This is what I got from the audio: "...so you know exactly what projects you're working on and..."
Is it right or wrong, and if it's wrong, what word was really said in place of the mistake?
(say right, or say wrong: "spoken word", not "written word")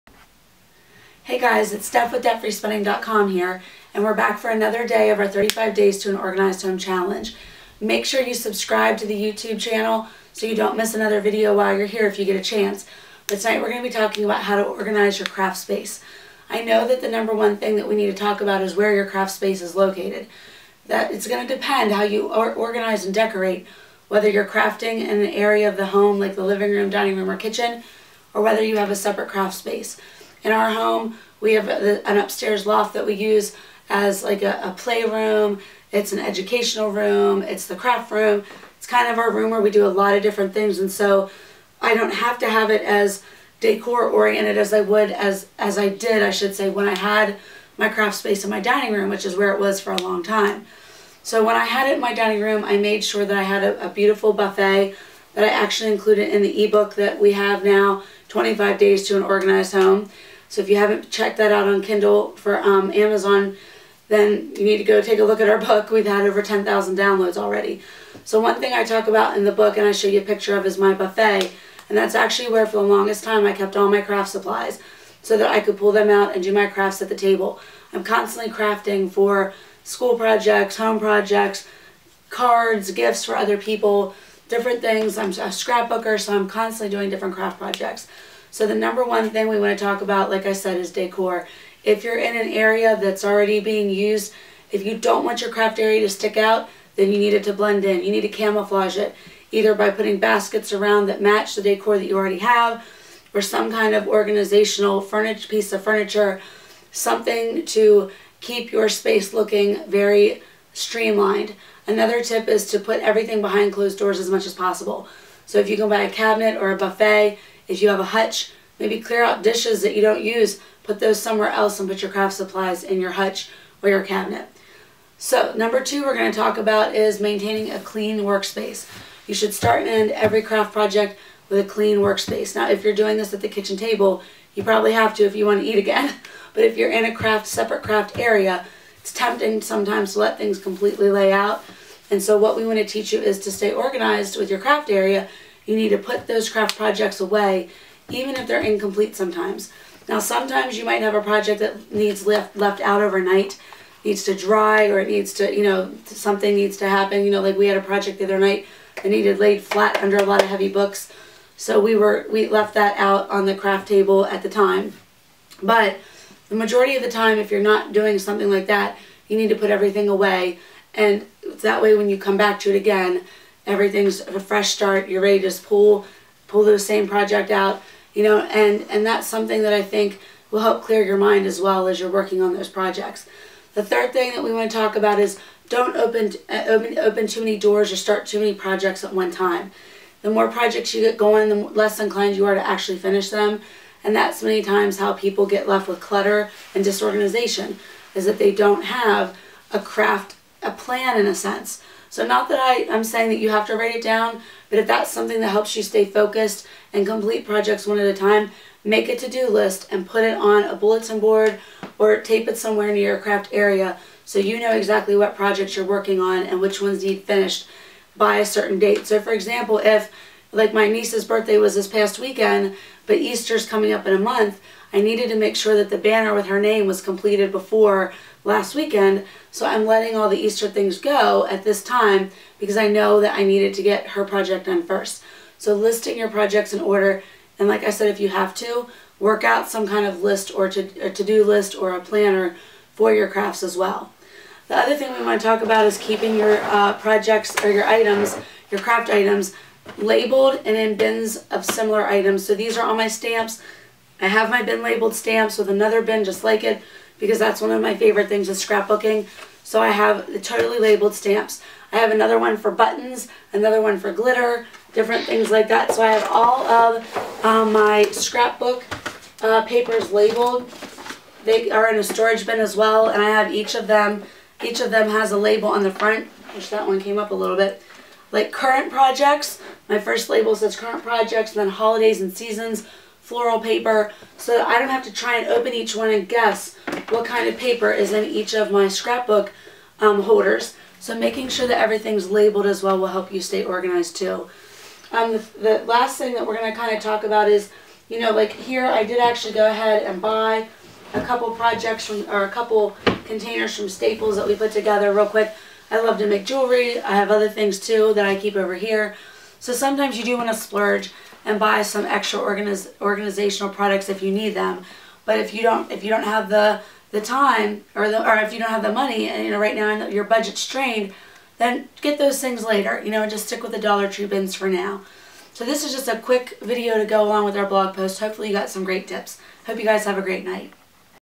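right.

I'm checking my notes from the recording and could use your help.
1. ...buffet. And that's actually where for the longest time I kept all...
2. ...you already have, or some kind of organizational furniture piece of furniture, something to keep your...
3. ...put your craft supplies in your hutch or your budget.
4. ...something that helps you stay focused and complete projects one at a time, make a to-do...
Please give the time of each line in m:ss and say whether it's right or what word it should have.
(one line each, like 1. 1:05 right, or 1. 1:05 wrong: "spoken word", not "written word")
1. 1:10 right
2. 1:42 right
3. 2:01 wrong: "cabinet", not "budget"
4. 3:25 right.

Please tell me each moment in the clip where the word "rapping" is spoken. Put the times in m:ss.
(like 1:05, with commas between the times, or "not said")
not said.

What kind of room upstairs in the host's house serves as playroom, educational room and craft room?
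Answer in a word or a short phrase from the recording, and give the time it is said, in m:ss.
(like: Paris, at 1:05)
loft, at 0:32.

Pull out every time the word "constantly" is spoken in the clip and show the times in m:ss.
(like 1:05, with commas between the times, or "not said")
1:18, 1:26.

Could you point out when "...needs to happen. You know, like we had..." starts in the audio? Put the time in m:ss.
2:36.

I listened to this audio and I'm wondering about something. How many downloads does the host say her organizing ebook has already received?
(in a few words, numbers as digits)
10,000.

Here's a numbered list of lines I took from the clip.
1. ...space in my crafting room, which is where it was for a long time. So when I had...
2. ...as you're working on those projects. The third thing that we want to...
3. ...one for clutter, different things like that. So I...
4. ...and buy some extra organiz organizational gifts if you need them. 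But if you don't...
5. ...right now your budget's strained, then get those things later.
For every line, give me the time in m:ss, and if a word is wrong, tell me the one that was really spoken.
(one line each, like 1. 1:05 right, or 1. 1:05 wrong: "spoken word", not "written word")
1. 0:48 wrong: "dining", not "crafting"
2. 3:01 right
3. 4:23 wrong: "glitter", not "clutter"
4. 5:11 wrong: "products", not "gifts"
5. 5:19 right.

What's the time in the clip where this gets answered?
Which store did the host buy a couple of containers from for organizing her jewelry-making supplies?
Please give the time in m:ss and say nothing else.
5:03.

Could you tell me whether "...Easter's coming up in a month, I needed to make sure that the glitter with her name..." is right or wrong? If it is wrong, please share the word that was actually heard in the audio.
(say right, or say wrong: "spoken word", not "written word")
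wrong: "banner", not "glitter".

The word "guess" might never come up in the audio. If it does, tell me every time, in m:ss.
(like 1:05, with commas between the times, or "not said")
4:46.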